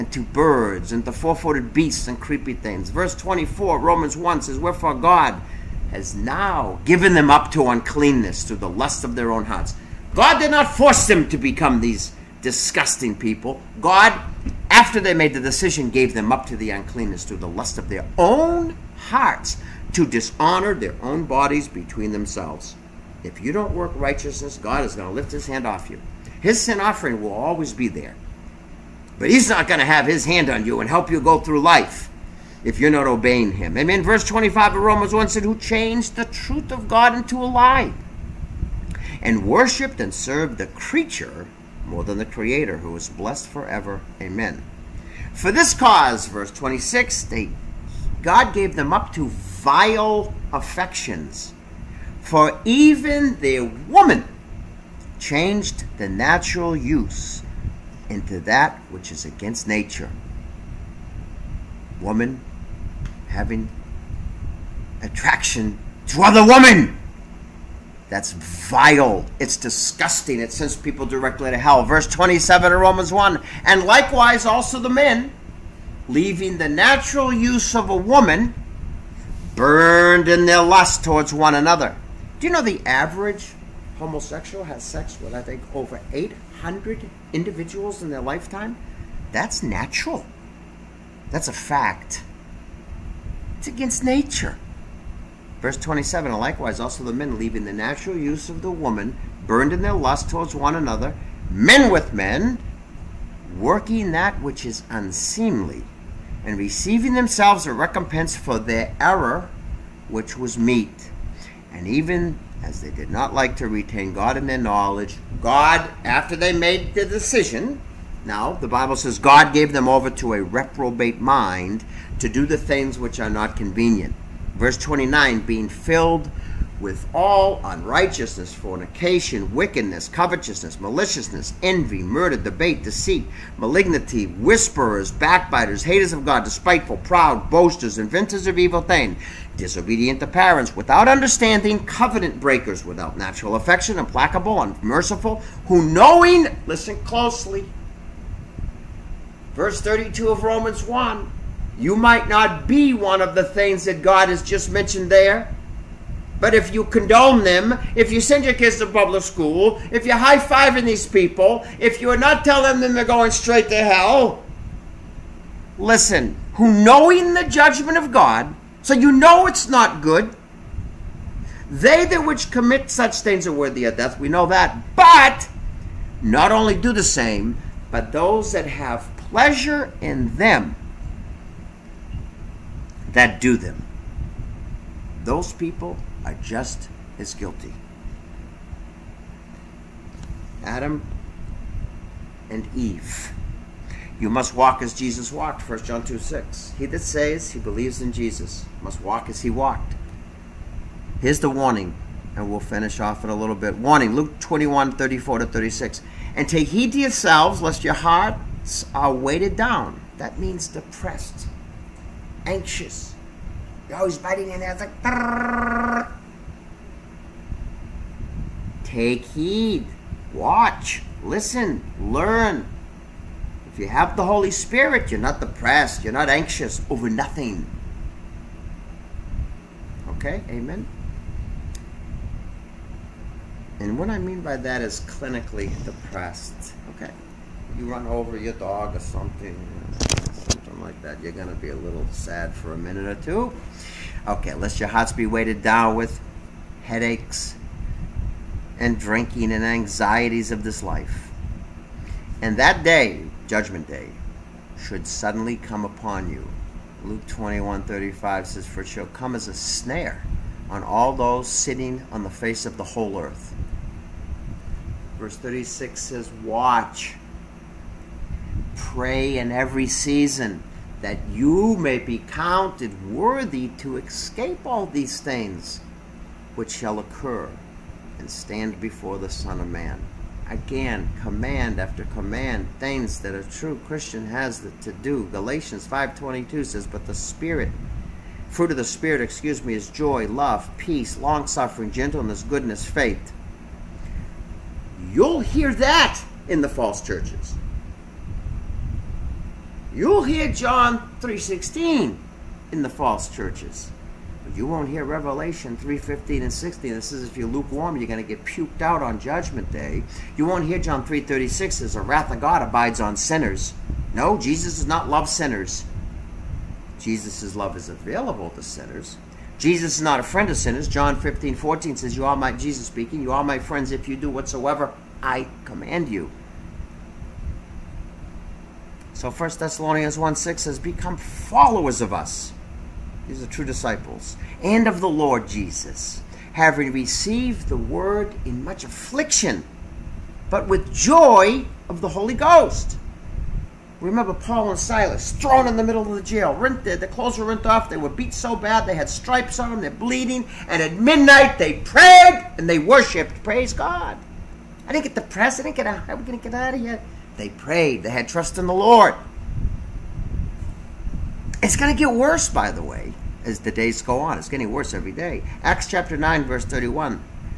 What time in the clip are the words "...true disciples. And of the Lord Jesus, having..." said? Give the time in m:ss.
5:33.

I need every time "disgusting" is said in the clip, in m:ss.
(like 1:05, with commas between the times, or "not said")
0:12, 1:09.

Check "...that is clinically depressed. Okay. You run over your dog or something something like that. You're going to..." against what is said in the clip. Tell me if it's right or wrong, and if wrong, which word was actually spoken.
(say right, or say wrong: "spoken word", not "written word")
right.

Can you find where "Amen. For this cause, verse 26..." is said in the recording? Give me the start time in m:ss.
0:44.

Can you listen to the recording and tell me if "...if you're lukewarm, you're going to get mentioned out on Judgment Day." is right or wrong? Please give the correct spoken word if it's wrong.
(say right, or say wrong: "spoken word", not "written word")
wrong: "puked", not "mentioned".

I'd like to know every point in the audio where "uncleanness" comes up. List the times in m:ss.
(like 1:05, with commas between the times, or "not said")
0:07, 0:16.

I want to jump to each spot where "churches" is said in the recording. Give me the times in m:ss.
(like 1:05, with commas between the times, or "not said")
4:57, 5:03.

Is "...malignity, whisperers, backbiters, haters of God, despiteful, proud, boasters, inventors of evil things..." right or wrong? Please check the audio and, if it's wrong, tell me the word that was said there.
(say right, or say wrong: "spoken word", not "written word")
right.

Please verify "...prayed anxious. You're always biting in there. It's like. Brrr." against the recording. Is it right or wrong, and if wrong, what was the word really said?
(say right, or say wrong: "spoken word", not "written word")
wrong: "depressed", not "prayed".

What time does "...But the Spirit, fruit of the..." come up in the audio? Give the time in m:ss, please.
4:46.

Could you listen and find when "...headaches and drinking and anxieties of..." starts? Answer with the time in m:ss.
4:06.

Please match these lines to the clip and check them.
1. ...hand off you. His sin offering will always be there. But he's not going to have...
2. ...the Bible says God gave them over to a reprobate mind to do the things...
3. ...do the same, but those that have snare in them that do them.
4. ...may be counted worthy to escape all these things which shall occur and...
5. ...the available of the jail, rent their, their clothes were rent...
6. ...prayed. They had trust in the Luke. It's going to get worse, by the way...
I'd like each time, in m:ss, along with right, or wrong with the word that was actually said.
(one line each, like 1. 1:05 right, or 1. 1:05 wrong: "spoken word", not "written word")
1. 0:25 right
2. 1:58 right
3. 2:56 wrong: "pleasure", not "snare"
4. 4:31 right
5. 5:45 wrong: "middle", not "available"
6. 5:57 wrong: "Lord", not "Luke".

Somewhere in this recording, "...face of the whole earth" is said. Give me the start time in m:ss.
4:22.